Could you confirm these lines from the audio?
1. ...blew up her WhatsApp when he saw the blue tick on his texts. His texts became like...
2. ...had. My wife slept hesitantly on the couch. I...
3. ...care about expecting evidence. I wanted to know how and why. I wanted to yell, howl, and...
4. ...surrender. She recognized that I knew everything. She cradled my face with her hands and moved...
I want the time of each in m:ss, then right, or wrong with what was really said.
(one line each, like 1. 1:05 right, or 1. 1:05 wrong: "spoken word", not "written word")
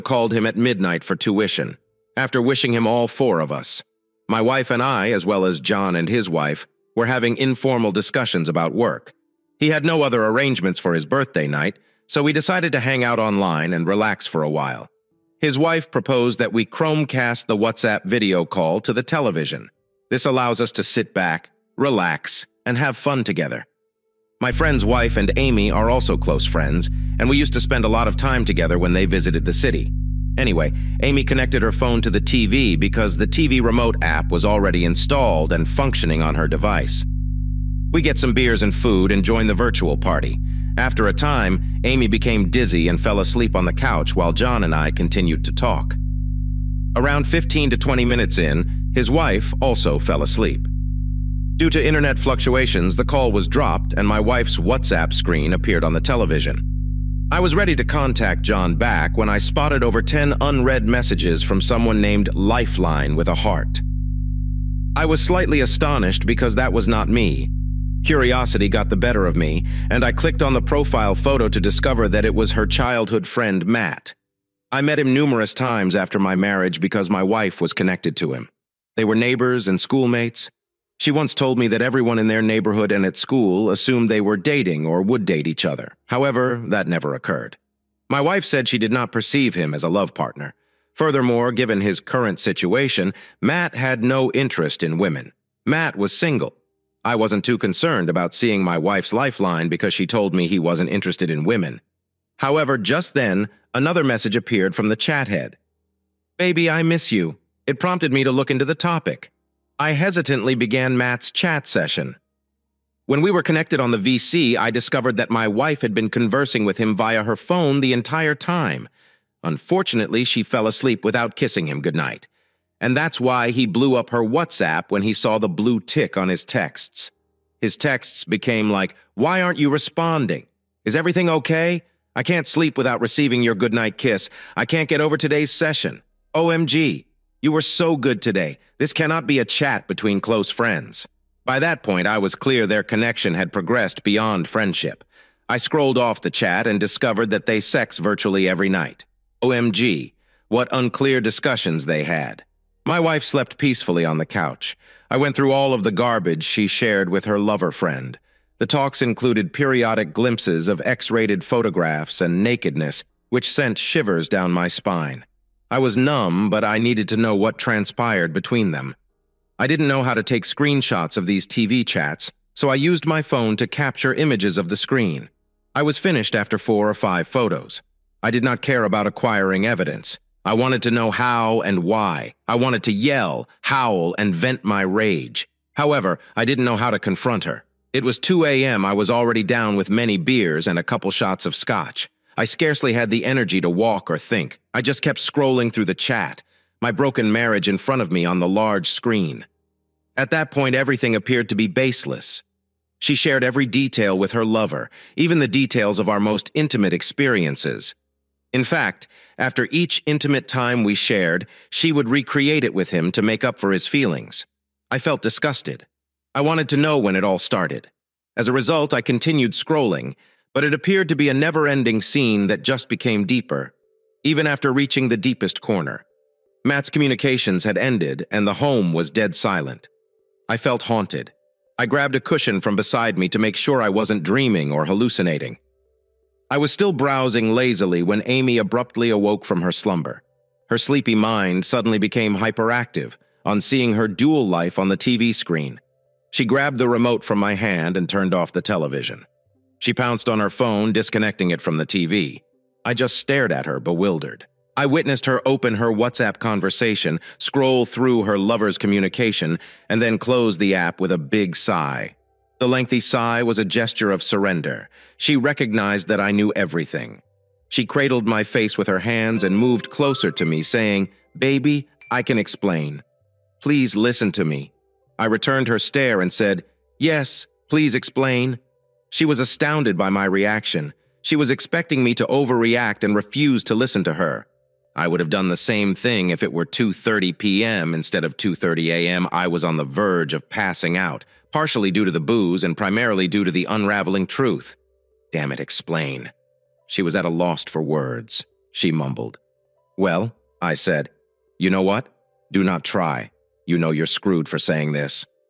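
1. 2:03 right
2. 2:32 wrong: "peacefully", not "hesitantly"
3. 2:58 wrong: "acquiring", not "expecting"
4. 4:24 right.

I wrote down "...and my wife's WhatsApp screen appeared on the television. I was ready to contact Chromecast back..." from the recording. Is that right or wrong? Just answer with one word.
wrong.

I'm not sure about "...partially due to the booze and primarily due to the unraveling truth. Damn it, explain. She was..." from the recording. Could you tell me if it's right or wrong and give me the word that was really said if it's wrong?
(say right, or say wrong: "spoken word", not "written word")
right.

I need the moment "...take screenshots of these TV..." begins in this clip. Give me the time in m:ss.
2:50.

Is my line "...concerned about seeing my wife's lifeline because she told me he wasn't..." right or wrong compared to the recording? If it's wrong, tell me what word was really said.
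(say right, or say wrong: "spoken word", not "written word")
right.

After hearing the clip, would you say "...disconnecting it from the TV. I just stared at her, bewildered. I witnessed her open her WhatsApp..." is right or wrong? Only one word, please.
right.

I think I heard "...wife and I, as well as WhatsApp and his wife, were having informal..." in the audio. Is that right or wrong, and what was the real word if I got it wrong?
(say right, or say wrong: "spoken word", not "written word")
wrong: "John", not "WhatsApp".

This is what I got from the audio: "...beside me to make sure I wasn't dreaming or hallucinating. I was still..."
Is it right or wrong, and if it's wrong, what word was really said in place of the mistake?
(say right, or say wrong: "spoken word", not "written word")
right.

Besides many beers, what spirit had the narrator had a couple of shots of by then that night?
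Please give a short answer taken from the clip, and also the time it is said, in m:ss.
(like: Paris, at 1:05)
scotch, at 3:11.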